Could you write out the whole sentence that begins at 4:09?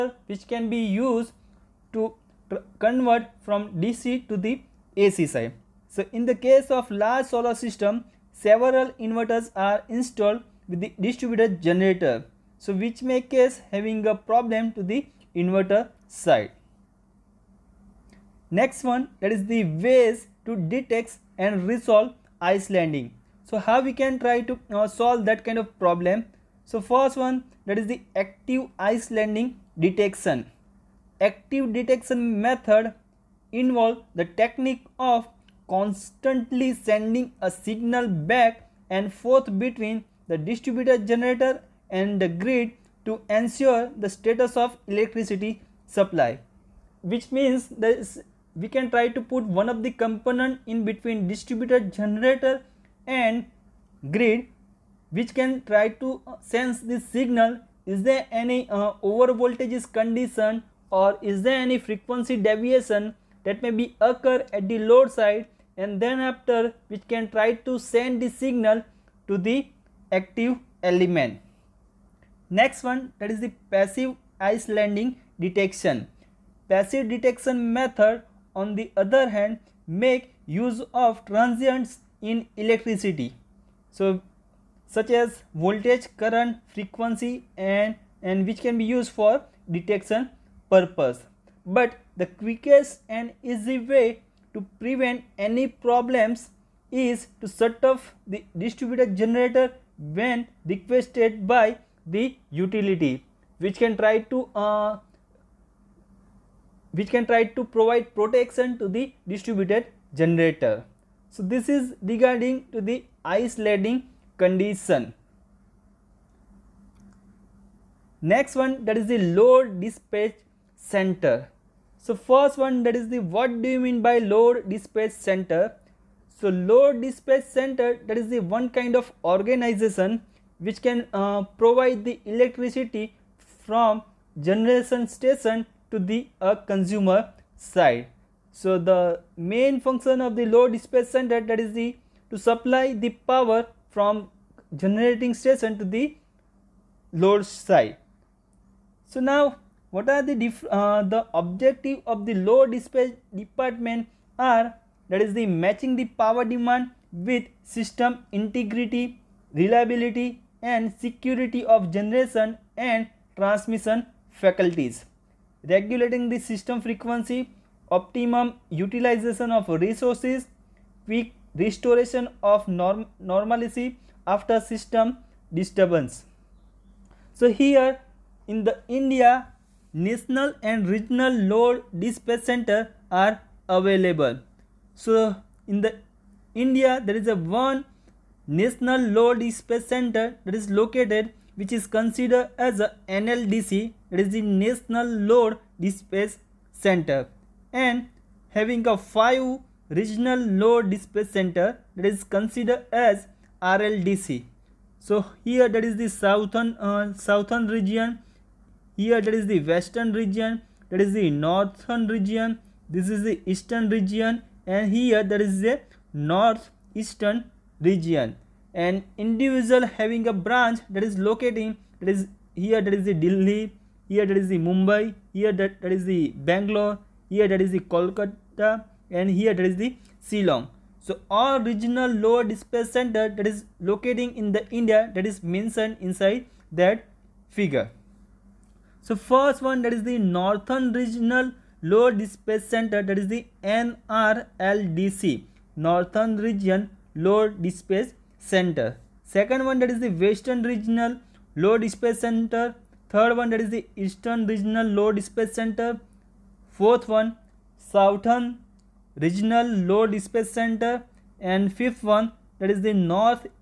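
Second one that is the western regional low dispatch center.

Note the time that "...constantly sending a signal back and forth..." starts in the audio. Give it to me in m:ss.
0:35.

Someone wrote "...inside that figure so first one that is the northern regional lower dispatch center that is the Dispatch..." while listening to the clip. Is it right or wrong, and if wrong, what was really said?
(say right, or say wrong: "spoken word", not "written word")
wrong: "NRLDC", not "Dispatch".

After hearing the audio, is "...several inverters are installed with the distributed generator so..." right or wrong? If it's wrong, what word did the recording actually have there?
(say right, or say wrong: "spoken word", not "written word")
right.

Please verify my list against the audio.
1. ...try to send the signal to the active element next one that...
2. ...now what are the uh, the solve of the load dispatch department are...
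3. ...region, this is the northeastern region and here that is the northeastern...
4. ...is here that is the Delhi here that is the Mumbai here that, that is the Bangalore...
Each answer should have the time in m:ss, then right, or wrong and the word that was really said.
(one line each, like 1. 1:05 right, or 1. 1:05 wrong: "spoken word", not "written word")
1. 1:07 right
2. 2:29 wrong: "objective", not "solve"
3. 3:32 wrong: "eastern", not "northeastern"
4. 3:42 right.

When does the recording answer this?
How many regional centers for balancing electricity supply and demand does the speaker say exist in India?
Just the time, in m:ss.
3:18.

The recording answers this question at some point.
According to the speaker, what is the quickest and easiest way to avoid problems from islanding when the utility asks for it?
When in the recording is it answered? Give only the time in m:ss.
1:37.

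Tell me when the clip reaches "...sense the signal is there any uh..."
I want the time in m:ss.
0:56.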